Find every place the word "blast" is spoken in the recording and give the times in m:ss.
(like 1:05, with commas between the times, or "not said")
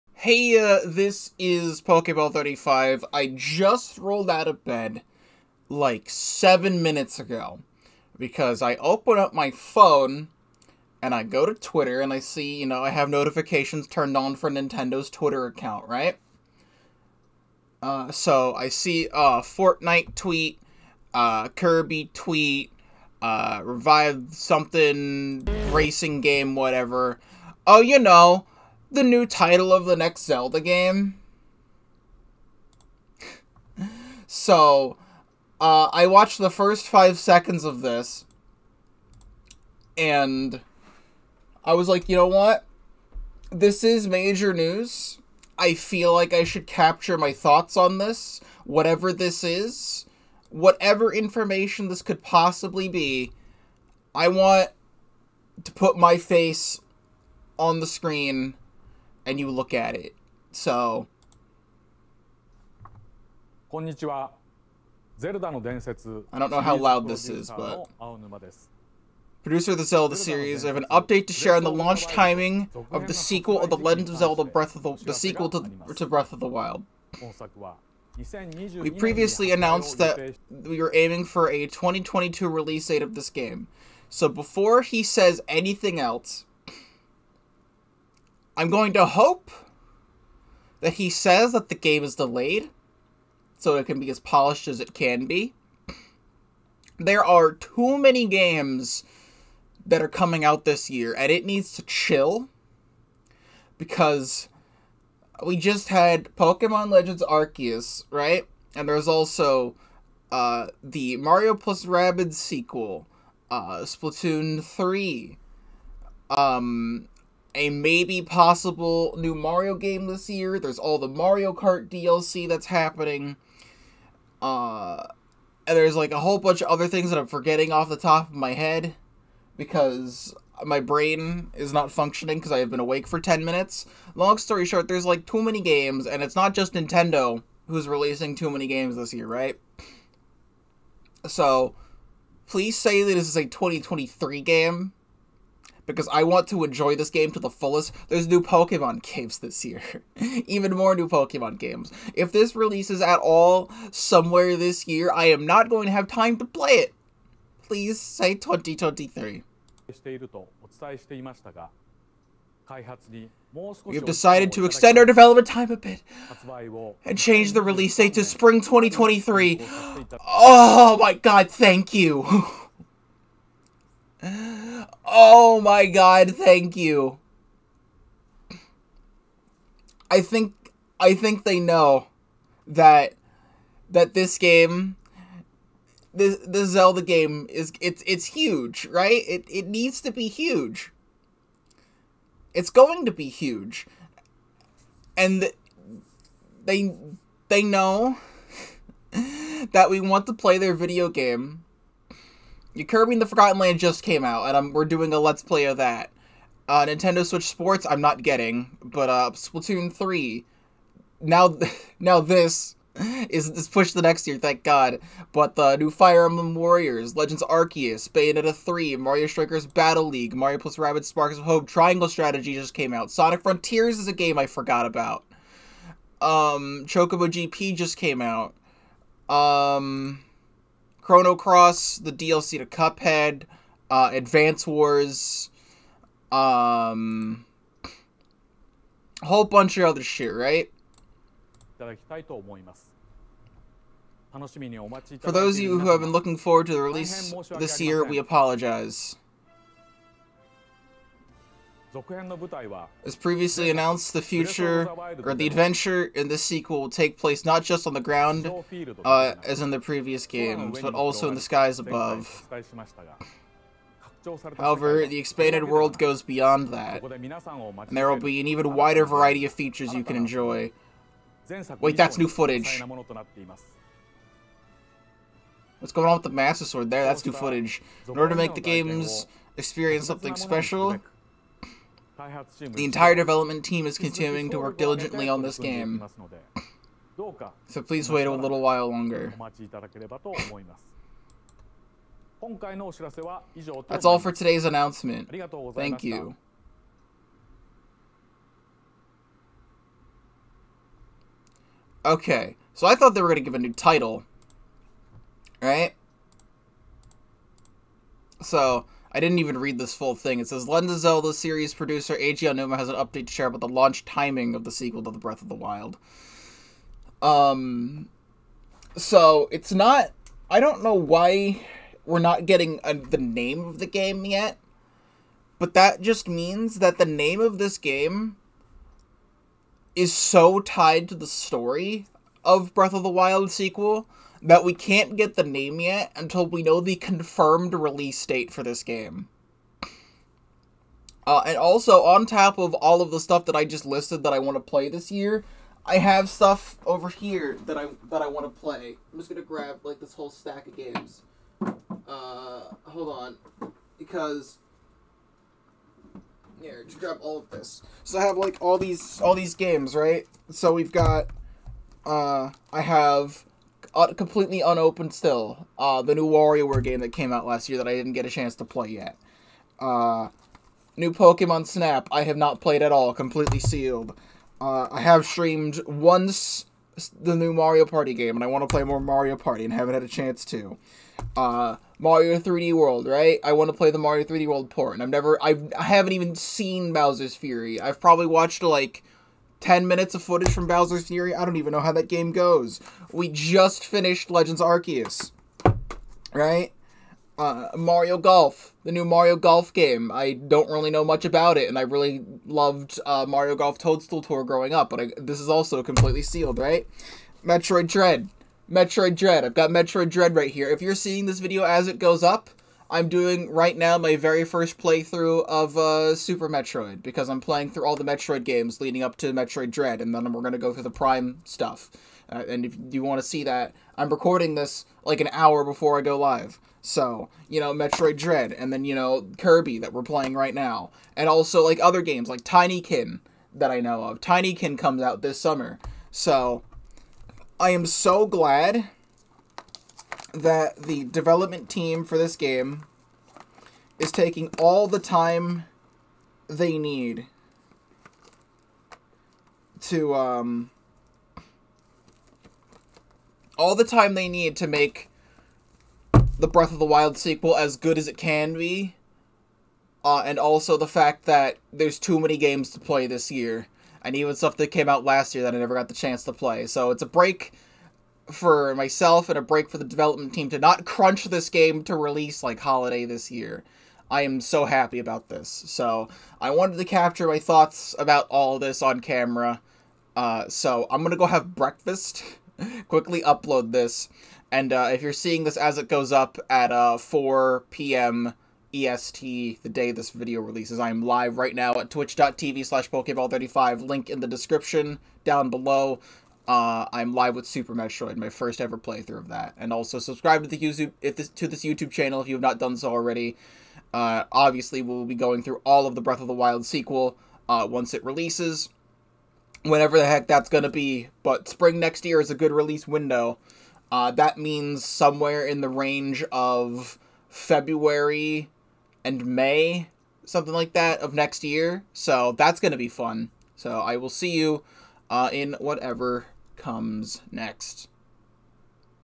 not said.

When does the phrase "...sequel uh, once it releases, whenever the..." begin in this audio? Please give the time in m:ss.
8:26.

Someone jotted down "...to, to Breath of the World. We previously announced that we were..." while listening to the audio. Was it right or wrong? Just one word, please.
wrong.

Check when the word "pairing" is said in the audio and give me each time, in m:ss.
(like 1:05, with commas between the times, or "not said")
not said.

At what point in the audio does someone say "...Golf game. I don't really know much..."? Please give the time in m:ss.
6:39.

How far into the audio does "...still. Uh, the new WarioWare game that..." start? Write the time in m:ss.
6:05.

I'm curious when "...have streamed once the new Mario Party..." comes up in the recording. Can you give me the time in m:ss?
6:15.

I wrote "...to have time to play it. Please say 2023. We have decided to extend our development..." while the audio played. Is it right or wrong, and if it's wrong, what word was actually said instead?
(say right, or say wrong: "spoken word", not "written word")
right.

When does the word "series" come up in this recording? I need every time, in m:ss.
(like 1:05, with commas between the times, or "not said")
1:10, 5:11.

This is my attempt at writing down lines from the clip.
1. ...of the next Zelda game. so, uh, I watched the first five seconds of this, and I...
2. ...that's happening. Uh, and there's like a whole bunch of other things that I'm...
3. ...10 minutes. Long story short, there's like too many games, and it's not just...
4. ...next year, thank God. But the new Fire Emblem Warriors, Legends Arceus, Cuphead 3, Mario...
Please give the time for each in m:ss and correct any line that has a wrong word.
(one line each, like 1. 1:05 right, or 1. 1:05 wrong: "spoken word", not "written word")
1. 0:29 right
2. 2:02 right
3. 2:13 right
4. 3:34 wrong: "Bayonetta", not "Cuphead".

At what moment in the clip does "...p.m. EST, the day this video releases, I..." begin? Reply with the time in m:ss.
8:07.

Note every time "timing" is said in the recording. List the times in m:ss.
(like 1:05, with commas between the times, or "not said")
1:12, 5:14.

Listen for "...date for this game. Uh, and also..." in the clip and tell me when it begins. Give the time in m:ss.
5:38.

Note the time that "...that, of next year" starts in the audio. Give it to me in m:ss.
8:40.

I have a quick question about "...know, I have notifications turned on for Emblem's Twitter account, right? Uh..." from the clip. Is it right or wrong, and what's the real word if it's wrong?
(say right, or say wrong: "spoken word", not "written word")
wrong: "Nintendo", not "Emblem".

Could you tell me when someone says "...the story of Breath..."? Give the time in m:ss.
5:31.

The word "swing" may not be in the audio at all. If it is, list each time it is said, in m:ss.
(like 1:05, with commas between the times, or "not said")
not said.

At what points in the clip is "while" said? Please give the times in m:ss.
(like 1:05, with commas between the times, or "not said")
4:48.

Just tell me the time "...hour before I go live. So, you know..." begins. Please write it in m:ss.
7:05.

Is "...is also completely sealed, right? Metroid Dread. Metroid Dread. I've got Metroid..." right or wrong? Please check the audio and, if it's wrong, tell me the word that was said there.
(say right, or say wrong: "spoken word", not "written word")
right.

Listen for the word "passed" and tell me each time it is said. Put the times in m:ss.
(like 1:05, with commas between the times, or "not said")
not said.